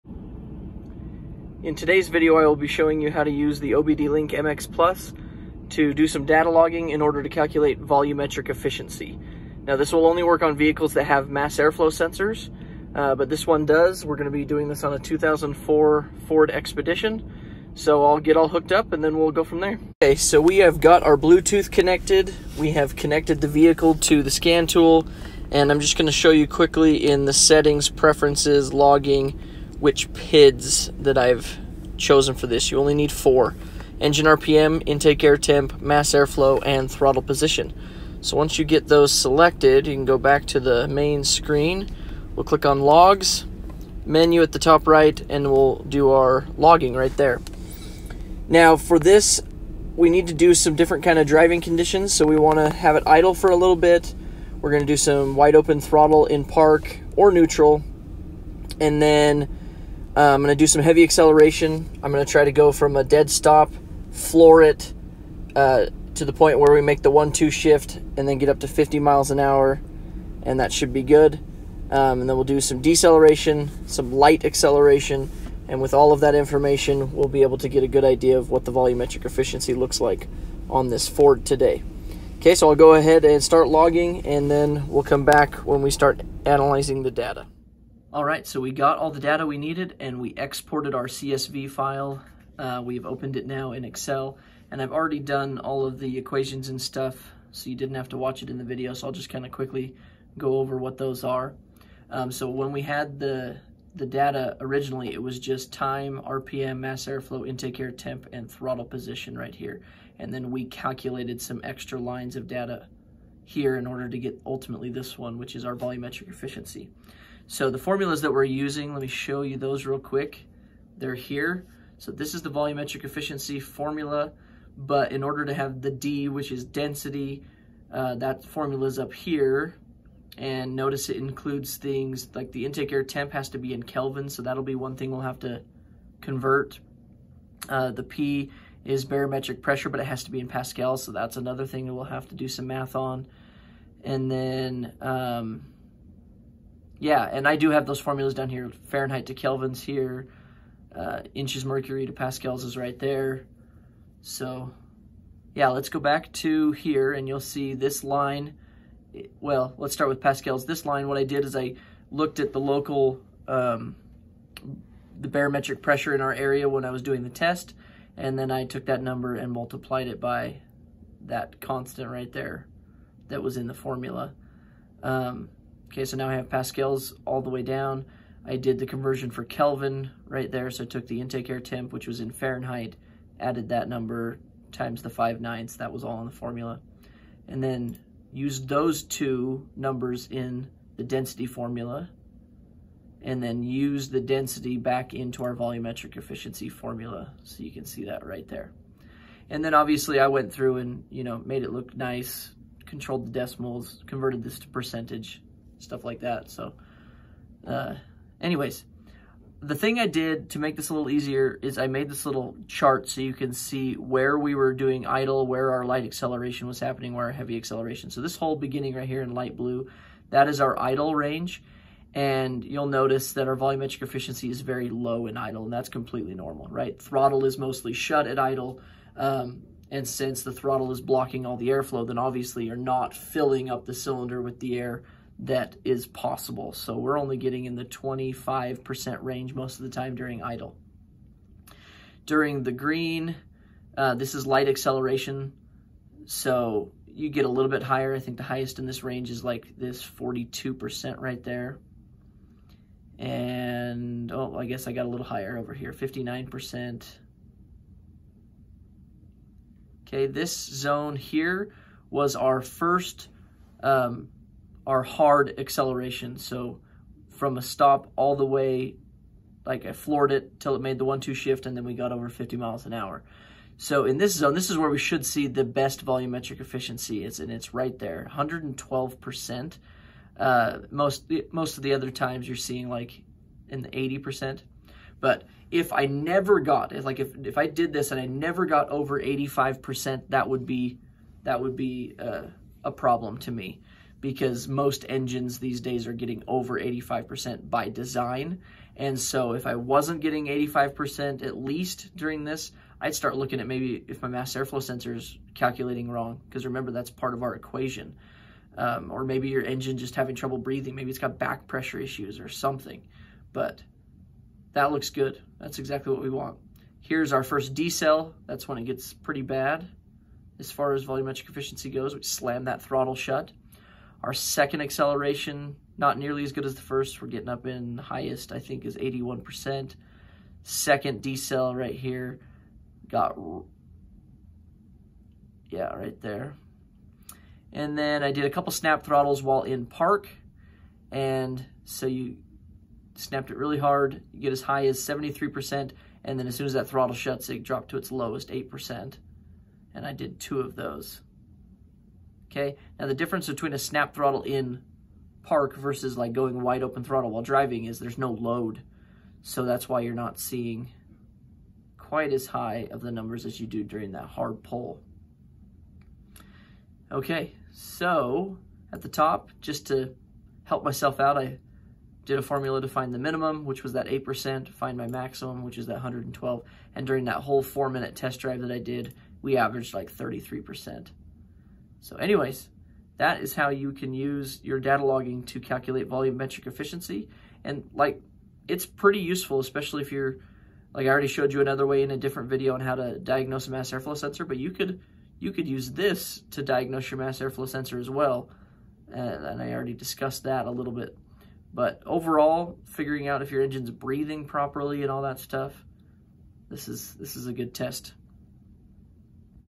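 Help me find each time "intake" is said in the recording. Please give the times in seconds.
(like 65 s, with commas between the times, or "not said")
34 s, 107 s, 132 s, 181 s.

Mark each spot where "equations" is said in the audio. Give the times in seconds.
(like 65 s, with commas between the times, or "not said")
96 s, 307 s.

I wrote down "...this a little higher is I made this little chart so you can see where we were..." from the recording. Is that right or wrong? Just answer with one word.
wrong.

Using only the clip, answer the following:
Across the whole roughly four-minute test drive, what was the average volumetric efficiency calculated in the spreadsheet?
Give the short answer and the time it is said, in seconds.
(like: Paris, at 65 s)
33%, at 380 s.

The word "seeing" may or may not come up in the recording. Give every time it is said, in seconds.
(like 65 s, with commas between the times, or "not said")
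282 s, 360 s.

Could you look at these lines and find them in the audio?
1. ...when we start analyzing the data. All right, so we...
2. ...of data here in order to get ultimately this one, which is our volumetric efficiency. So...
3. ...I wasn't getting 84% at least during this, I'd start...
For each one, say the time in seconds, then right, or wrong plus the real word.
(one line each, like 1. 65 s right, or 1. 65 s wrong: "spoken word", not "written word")
1. 85 s right
2. 112 s right
3. 299 s wrong: "85", not "84".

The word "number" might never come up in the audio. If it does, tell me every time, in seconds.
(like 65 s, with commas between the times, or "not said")
169 s, 183 s, 189 s, 363 s.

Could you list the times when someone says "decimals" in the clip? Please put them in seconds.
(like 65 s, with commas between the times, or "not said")
203 s.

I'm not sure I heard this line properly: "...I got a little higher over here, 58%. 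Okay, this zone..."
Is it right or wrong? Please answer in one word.
wrong.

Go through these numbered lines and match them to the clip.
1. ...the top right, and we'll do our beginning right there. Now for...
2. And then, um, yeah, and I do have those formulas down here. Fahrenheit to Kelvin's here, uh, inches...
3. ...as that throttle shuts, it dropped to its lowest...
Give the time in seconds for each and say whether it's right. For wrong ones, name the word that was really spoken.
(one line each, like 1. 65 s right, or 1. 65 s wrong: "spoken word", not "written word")
1. 44 s wrong: "logging", not "beginning"
2. 144 s right
3. 346 s right.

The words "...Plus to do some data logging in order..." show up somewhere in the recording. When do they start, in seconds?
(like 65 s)
4 s.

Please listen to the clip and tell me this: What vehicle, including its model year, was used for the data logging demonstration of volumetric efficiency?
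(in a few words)
2004 Ford Expedition.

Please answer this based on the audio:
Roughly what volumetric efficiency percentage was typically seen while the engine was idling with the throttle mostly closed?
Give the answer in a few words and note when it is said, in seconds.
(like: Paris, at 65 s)
25%, at 237 s.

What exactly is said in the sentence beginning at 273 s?
So in this zone, this is where we should see the best volumetric efficiency.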